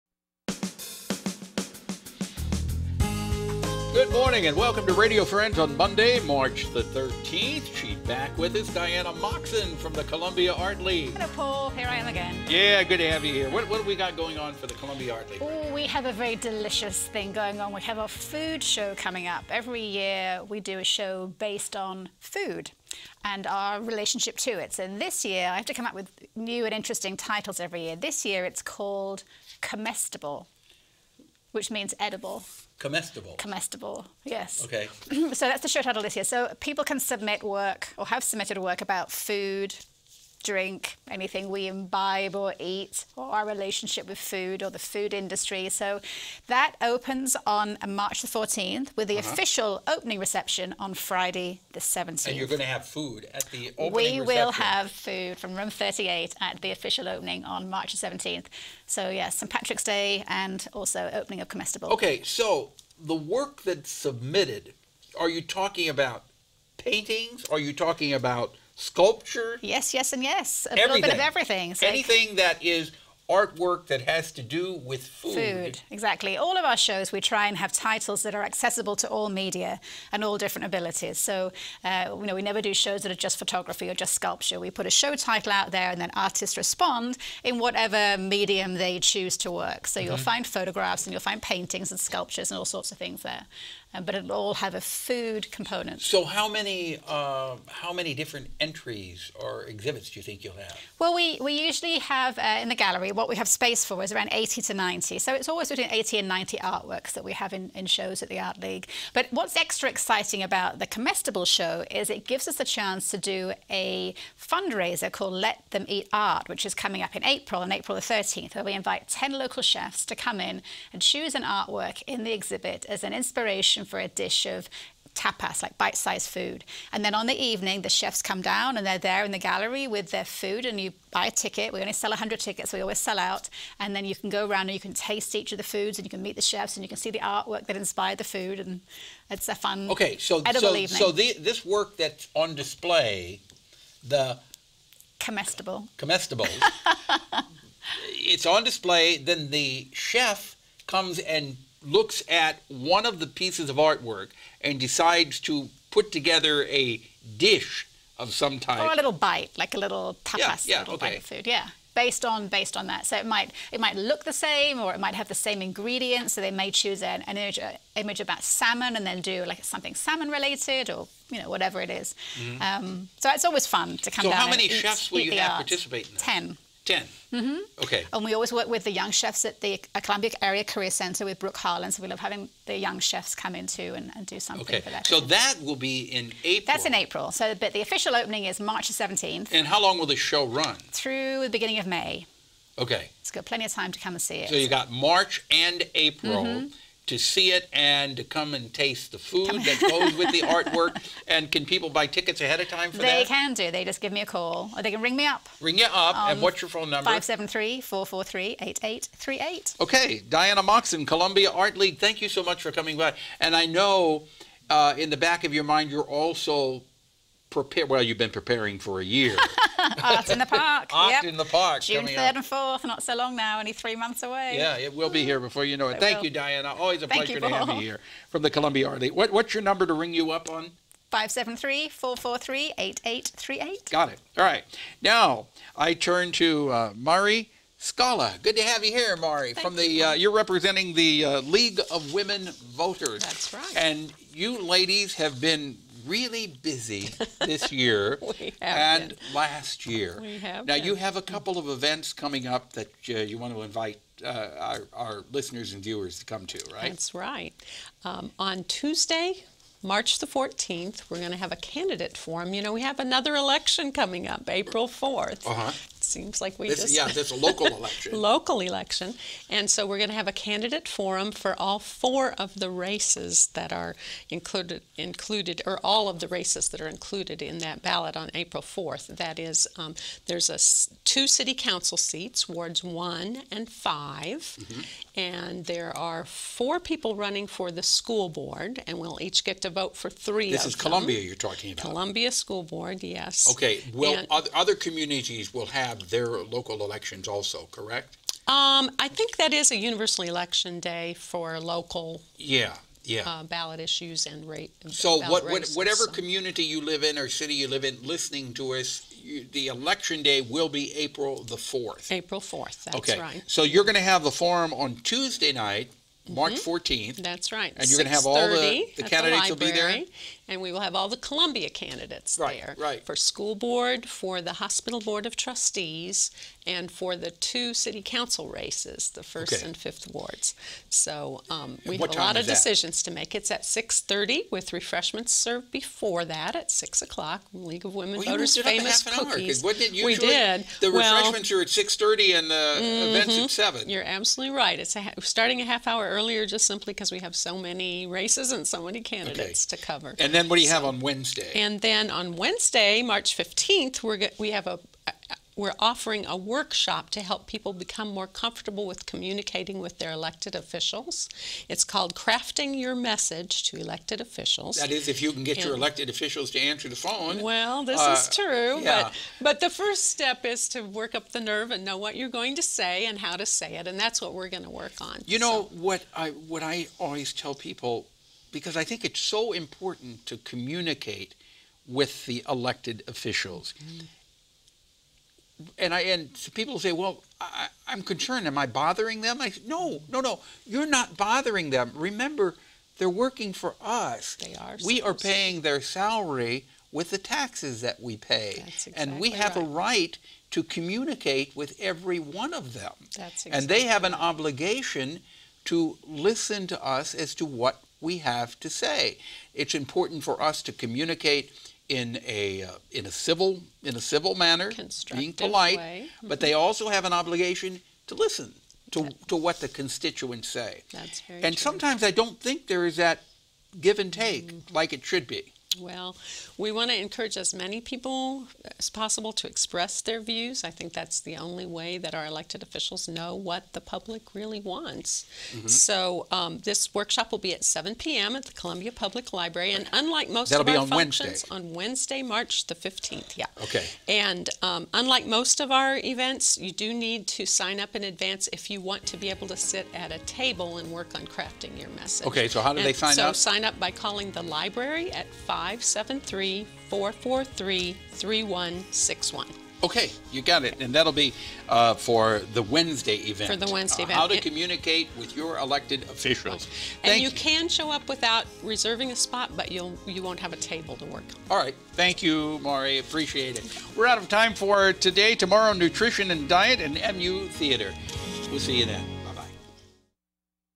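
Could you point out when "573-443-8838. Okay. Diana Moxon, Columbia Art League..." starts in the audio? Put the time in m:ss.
3:27.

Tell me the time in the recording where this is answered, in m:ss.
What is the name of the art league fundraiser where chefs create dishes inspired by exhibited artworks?
1:55.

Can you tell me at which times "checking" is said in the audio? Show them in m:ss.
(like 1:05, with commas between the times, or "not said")
not said.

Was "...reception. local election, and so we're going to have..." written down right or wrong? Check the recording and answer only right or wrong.
wrong.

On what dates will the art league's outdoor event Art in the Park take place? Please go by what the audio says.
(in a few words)
June 3rd and 4th.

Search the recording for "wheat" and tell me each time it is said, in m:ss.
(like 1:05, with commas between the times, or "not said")
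not said.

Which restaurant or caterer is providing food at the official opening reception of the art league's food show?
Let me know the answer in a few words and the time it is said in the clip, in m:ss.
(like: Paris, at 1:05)
Room 38, at 0:55.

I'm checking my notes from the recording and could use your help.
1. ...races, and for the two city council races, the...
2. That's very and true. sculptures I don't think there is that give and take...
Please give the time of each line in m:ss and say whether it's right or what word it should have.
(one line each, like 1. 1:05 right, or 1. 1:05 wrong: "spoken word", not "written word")
1. 5:25 wrong: "trustees", not "races"
2. 7:00 wrong: "sometimes", not "sculptures".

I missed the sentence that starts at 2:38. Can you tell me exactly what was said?
Or a little bite, like a little tapas, yeah, yeah, little okay.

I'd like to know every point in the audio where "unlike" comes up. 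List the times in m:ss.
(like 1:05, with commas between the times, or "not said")
7:19, 7:24.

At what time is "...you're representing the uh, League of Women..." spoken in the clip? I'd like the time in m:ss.
4:00.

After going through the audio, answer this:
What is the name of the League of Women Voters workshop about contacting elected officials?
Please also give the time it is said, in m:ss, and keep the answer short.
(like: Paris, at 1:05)
Crafting Your Message to Elected Officials, at 6:02.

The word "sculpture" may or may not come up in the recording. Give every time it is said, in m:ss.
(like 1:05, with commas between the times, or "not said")
1:08, 1:24, 1:31.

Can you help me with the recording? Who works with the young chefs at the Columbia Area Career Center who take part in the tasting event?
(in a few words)
Brooke Harlan.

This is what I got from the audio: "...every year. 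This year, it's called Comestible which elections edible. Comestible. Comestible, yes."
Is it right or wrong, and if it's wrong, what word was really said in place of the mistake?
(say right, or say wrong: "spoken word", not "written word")
wrong: "means", not "elections".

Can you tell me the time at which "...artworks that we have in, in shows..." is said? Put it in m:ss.
1:46.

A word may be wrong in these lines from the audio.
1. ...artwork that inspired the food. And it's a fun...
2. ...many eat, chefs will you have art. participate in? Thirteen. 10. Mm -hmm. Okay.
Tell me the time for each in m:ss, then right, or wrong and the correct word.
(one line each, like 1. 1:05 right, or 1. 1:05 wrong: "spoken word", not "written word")
1. 2:17 right
2. 2:54 wrong: "Ten", not "Thirteen".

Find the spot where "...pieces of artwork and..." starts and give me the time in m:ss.
2:33.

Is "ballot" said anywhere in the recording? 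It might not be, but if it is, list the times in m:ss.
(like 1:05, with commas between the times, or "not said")
4:37, 5:03.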